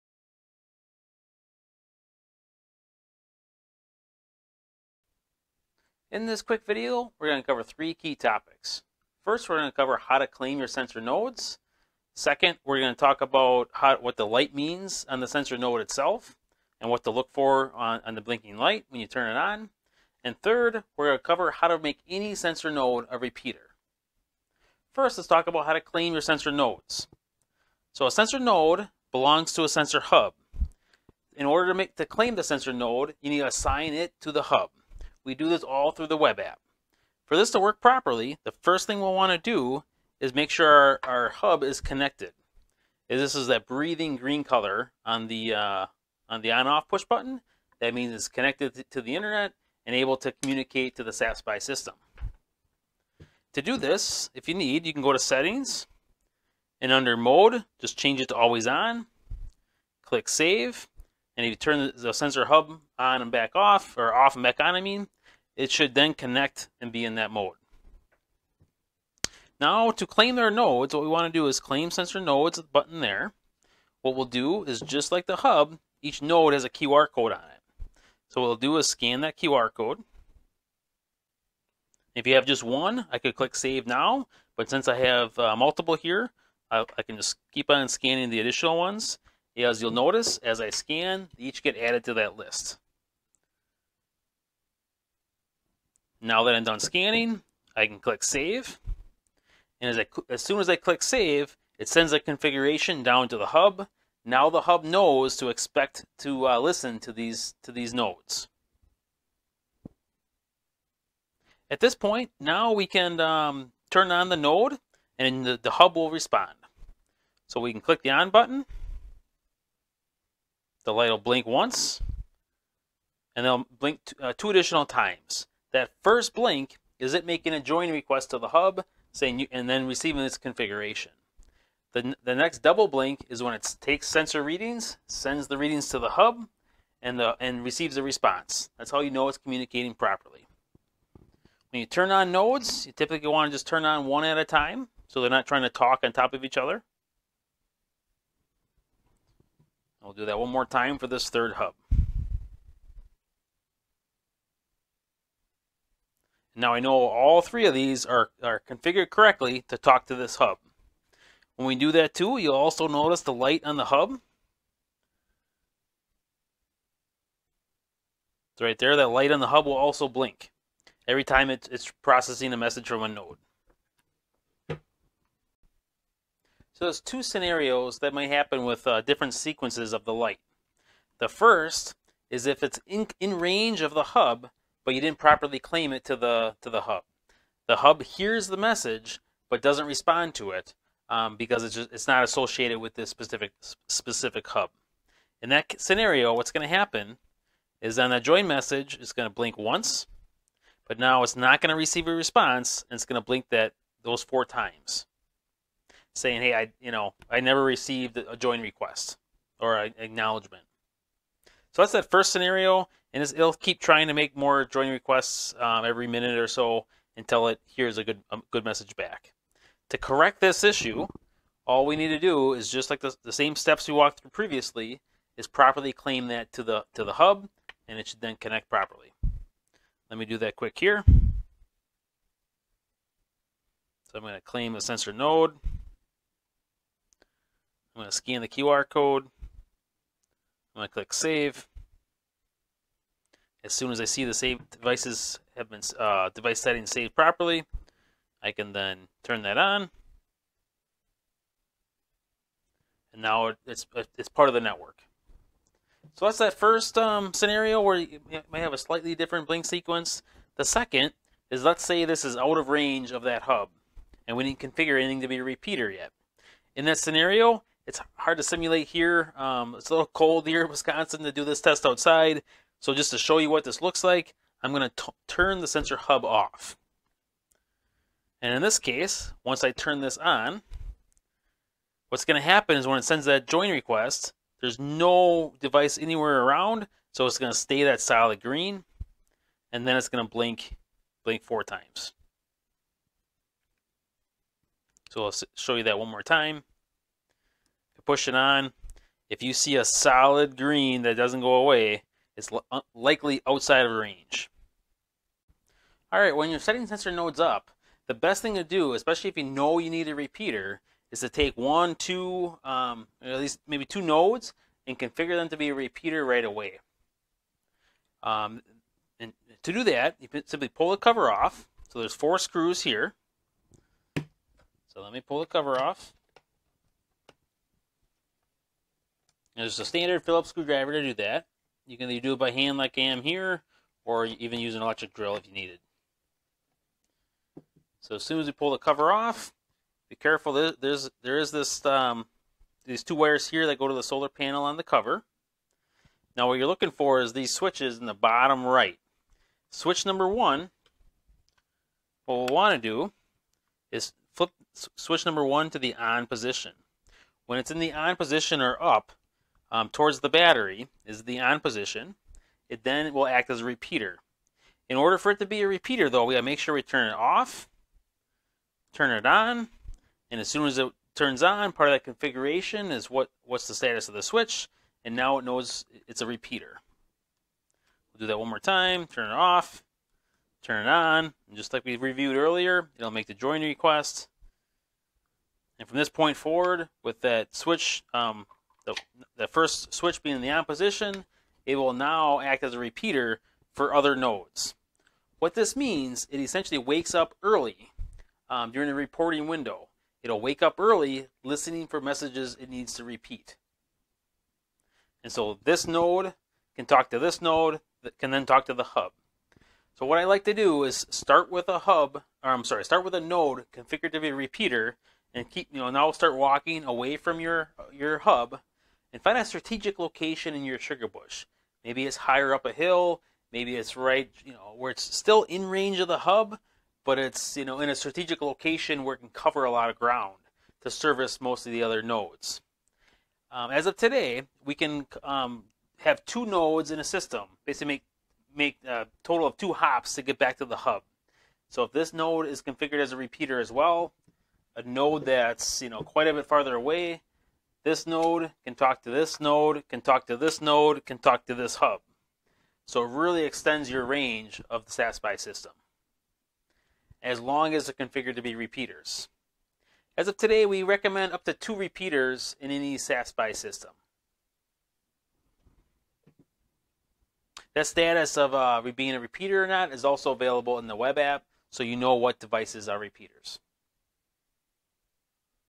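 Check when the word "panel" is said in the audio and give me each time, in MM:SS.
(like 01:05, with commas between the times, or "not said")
05:44.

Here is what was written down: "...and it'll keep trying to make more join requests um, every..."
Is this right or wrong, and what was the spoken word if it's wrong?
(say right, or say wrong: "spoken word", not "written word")
right.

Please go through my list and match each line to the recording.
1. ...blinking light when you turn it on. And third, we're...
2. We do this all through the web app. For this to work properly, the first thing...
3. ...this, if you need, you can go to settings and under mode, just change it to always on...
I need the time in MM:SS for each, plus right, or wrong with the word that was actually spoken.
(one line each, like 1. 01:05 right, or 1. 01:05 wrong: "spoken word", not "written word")
1. 00:18 right
2. 00:35 right
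3. 00:53 right.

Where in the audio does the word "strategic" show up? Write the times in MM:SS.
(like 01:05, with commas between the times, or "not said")
06:59, 07:07.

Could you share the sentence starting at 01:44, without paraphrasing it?
Now the hub knows to expect to uh, listen to these, to these nodes.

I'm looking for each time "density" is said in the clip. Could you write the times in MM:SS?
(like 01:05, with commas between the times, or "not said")
not said.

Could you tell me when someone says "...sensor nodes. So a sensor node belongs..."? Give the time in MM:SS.
00:26.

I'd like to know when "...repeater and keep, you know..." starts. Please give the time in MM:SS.
06:54.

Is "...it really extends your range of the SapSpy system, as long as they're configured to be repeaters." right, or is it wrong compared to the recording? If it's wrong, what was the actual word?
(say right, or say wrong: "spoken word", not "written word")
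right.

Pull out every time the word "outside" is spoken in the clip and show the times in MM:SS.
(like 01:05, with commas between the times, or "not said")
04:31, 05:03.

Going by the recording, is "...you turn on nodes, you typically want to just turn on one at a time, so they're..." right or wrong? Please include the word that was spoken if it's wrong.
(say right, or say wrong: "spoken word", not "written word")
right.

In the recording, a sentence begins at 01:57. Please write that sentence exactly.
So we can click the on button the light will blink once, and they'll blink uh, two additional times.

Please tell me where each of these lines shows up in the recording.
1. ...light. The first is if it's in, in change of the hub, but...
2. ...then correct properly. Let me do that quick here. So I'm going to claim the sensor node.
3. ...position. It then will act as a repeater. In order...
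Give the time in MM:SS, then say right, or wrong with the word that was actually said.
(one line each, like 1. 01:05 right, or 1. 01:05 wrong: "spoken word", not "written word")
1. 03:00 wrong: "range", not "change"
2. 03:48 wrong: "connect", not "correct"
3. 06:01 right.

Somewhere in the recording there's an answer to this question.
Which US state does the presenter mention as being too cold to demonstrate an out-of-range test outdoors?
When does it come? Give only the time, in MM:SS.
04:30.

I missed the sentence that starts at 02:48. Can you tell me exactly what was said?
It's right there, that light on the hub will also blink every time it's, it's processing a message from a node.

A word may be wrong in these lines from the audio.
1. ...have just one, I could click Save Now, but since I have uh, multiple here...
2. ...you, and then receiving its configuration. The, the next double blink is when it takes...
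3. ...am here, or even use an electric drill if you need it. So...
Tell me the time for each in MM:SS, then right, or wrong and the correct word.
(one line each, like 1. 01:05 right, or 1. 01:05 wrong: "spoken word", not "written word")
1. 01:22 right
2. 02:09 right
3. 05:33 right.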